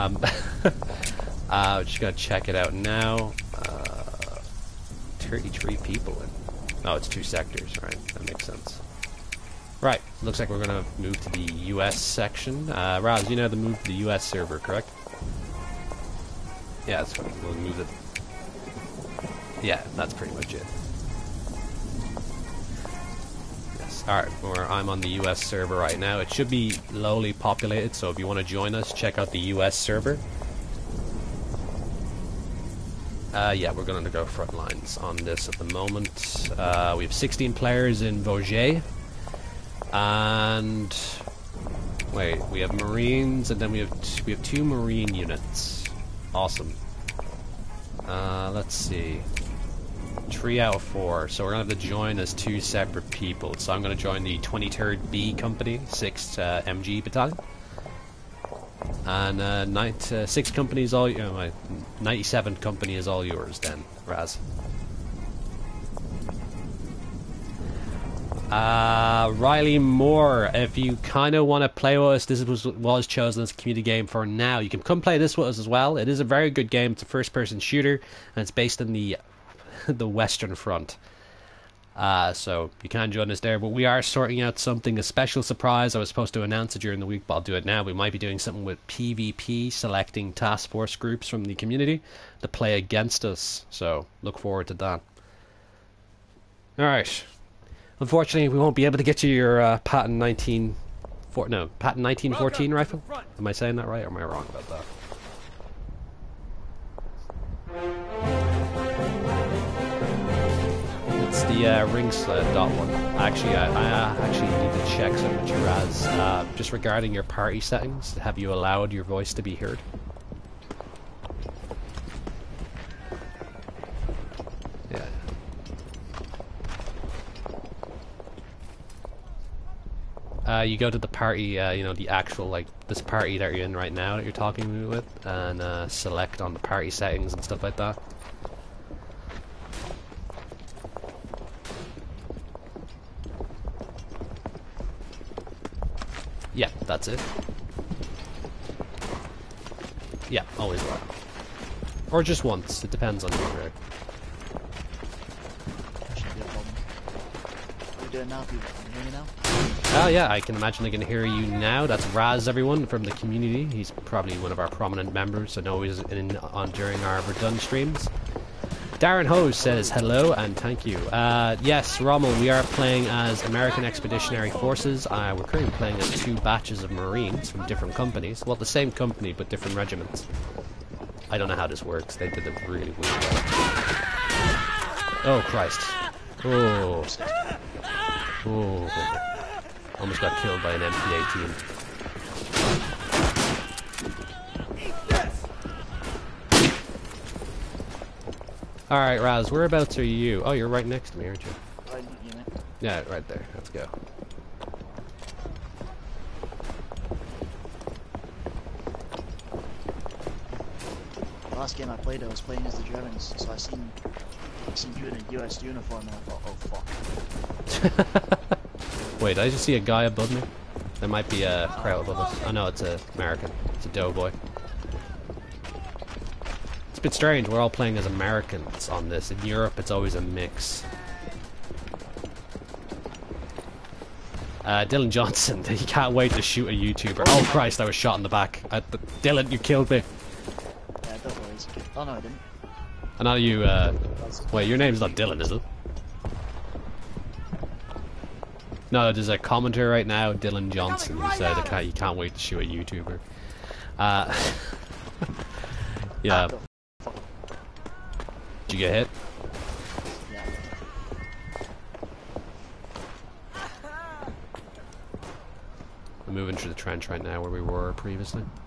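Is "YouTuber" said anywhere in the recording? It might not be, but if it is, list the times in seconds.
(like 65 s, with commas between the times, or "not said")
236 s, 252 s.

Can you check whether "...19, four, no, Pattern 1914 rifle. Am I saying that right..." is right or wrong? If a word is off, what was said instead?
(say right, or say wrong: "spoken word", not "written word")
right.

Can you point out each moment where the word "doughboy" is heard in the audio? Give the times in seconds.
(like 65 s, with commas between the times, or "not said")
223 s.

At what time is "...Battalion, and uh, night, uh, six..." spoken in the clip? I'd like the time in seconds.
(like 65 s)
57 s.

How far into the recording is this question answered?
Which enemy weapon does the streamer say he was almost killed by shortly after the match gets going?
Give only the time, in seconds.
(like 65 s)
190 s.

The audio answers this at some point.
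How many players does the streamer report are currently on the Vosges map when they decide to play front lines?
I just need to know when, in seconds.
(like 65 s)
37 s.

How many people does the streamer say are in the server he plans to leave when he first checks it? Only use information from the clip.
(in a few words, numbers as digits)
33.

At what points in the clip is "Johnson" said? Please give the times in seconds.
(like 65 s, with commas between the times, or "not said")
235 s, 250 s.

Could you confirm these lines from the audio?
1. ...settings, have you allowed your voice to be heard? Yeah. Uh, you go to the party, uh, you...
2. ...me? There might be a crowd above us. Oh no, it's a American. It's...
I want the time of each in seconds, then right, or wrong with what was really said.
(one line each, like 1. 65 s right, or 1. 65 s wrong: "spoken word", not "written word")
1. 117 s right
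2. 220 s right.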